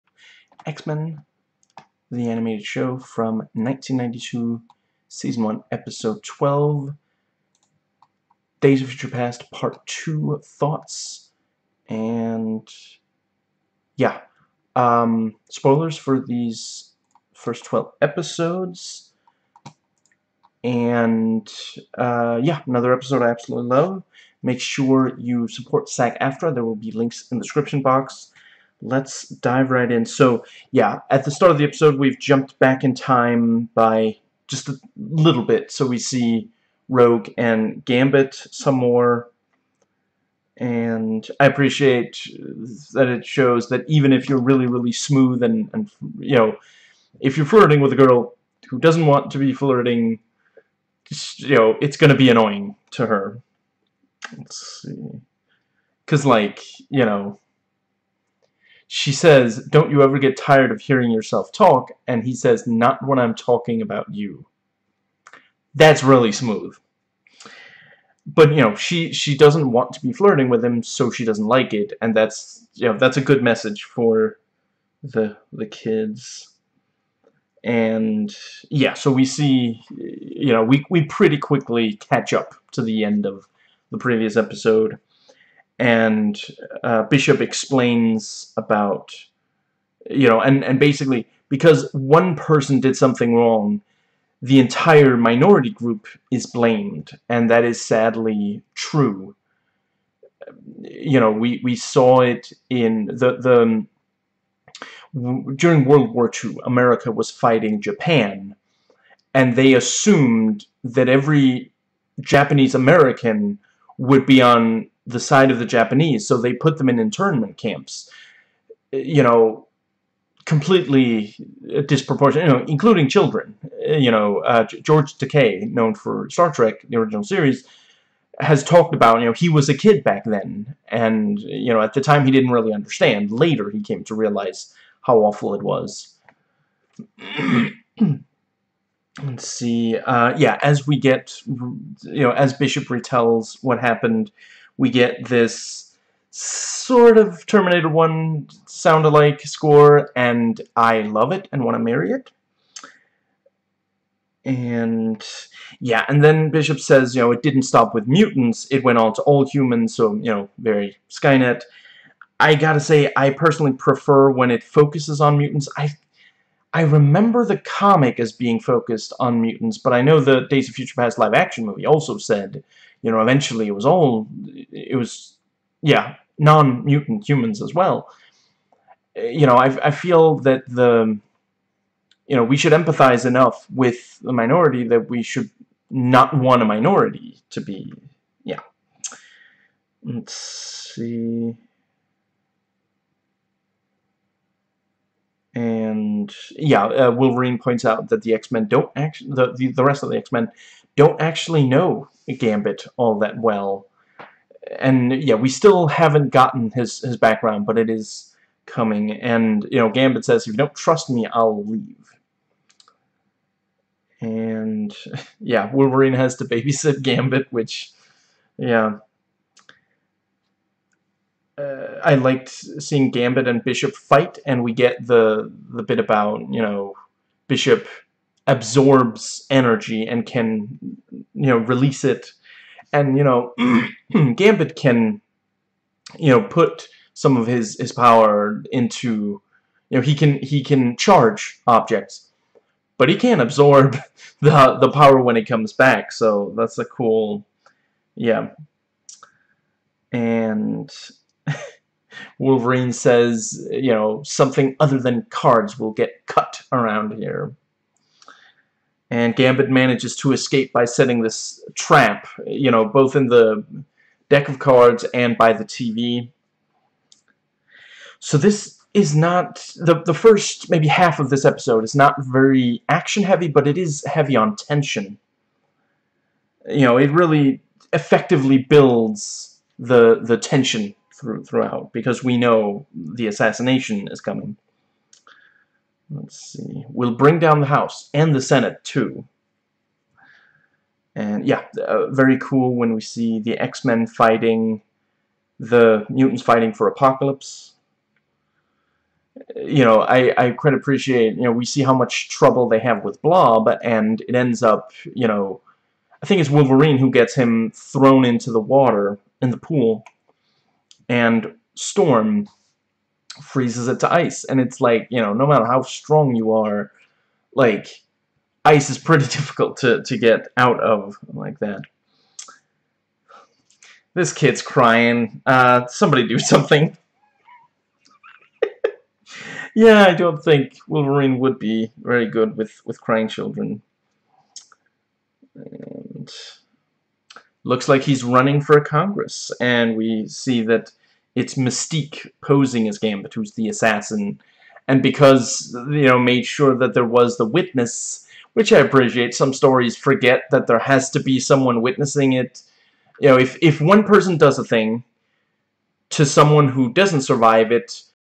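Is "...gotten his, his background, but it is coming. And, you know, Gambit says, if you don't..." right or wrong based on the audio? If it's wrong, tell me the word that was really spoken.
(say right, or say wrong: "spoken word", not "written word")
right.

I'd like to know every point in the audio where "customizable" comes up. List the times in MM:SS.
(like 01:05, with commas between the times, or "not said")
not said.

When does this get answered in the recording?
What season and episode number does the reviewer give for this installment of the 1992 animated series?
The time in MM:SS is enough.
00:05.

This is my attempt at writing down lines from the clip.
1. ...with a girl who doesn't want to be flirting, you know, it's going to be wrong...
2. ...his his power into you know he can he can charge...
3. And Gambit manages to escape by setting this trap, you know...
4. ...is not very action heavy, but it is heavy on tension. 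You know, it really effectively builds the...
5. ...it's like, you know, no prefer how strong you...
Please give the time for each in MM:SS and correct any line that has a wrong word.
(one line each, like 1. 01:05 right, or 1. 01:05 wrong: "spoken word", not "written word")
1. 00:47 wrong: "annoying", not "wrong"
2. 03:57 right
3. 04:19 right
4. 04:31 right
5. 05:14 wrong: "matter", not "prefer".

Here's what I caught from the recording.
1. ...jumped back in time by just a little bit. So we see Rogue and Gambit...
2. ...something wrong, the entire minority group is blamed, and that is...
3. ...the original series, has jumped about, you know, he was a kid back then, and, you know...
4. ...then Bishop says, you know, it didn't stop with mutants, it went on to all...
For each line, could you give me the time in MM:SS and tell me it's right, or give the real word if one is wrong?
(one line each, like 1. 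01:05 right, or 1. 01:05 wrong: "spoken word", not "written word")
1. 00:32 right
2. 01:32 right
3. 02:06 wrong: "talked", not "jumped"
4. 02:36 right.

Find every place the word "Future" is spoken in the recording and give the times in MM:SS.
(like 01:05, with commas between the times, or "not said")
00:08, 02:50.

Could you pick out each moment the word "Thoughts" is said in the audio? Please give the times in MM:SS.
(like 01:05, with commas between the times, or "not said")
00:10.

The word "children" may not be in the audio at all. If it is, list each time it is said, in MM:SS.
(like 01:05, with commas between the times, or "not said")
02:03, 05:33.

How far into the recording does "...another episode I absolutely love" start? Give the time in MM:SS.
00:22.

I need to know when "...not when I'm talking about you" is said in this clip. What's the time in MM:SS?
01:02.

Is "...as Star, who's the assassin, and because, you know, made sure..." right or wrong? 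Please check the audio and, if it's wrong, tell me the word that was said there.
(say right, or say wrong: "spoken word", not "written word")
wrong: "Gambit", not "Star".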